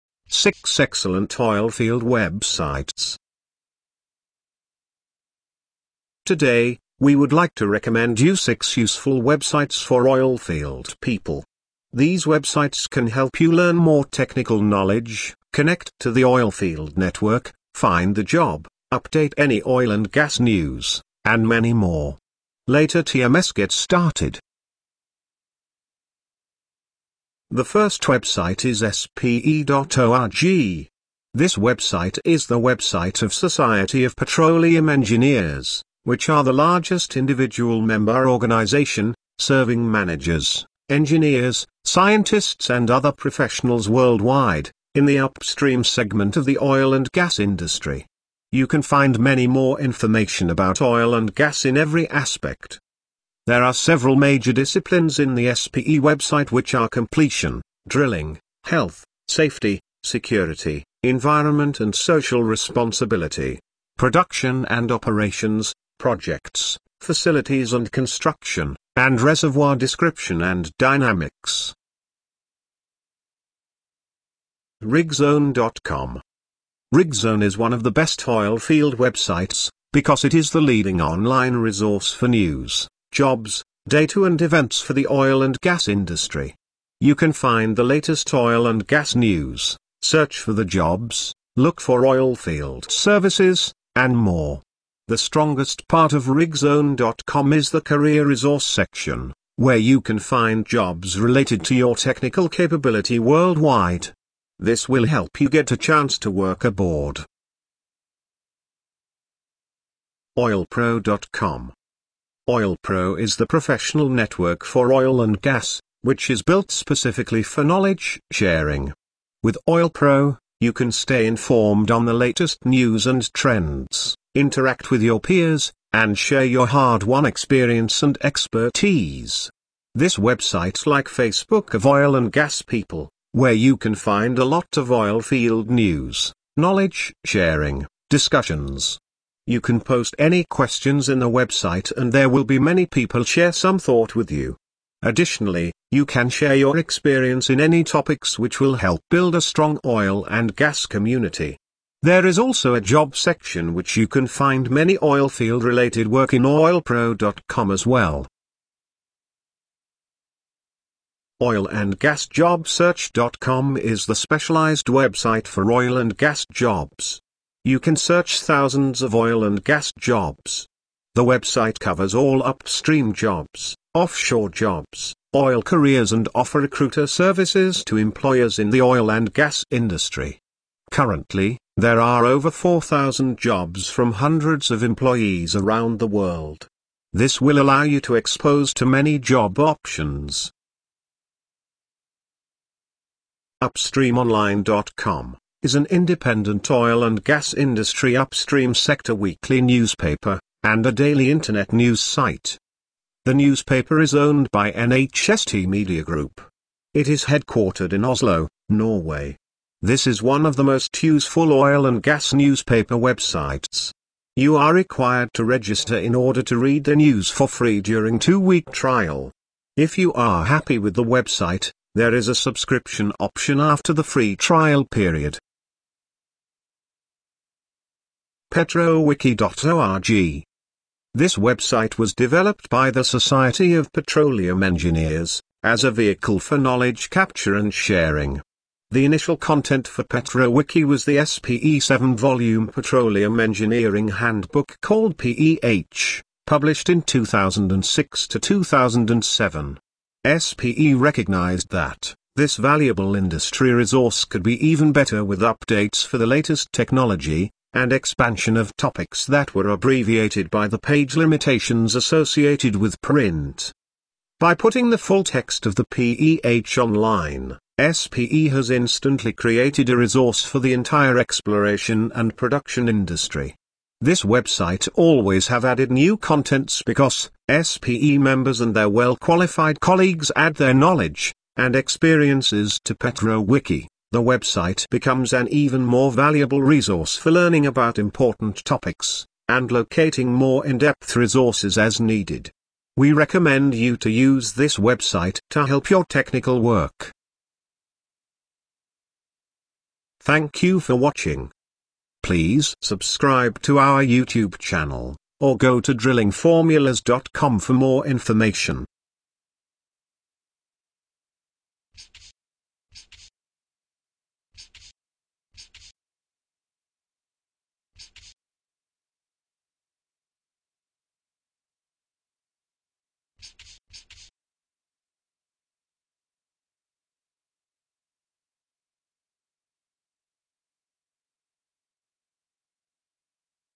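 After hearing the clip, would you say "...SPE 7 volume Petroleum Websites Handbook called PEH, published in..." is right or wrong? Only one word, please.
wrong.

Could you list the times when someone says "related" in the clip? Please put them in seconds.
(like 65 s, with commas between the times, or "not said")
101 s, 155 s.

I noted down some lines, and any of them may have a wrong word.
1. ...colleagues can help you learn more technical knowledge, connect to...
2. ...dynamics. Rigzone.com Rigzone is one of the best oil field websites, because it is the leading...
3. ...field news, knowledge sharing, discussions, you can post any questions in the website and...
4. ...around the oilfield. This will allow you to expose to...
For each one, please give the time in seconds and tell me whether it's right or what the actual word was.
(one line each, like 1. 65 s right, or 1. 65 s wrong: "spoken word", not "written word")
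1. 12 s wrong: "websites", not "colleagues"
2. 70 s right
3. 135 s right
4. 185 s wrong: "world", not "oilfield".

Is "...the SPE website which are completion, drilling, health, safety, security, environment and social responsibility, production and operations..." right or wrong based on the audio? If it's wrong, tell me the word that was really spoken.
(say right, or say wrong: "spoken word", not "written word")
right.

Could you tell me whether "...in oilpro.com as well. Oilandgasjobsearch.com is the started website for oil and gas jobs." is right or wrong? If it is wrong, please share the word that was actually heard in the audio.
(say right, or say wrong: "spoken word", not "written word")
wrong: "specialized", not "started".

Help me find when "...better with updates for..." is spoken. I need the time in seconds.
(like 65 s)
254 s.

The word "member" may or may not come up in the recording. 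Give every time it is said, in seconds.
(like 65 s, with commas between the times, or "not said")
37 s, 278 s.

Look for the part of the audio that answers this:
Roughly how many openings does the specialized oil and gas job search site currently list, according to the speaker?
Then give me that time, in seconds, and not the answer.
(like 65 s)
182 s.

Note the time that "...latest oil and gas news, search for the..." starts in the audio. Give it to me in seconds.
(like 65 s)
87 s.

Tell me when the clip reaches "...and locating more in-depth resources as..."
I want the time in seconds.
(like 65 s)
289 s.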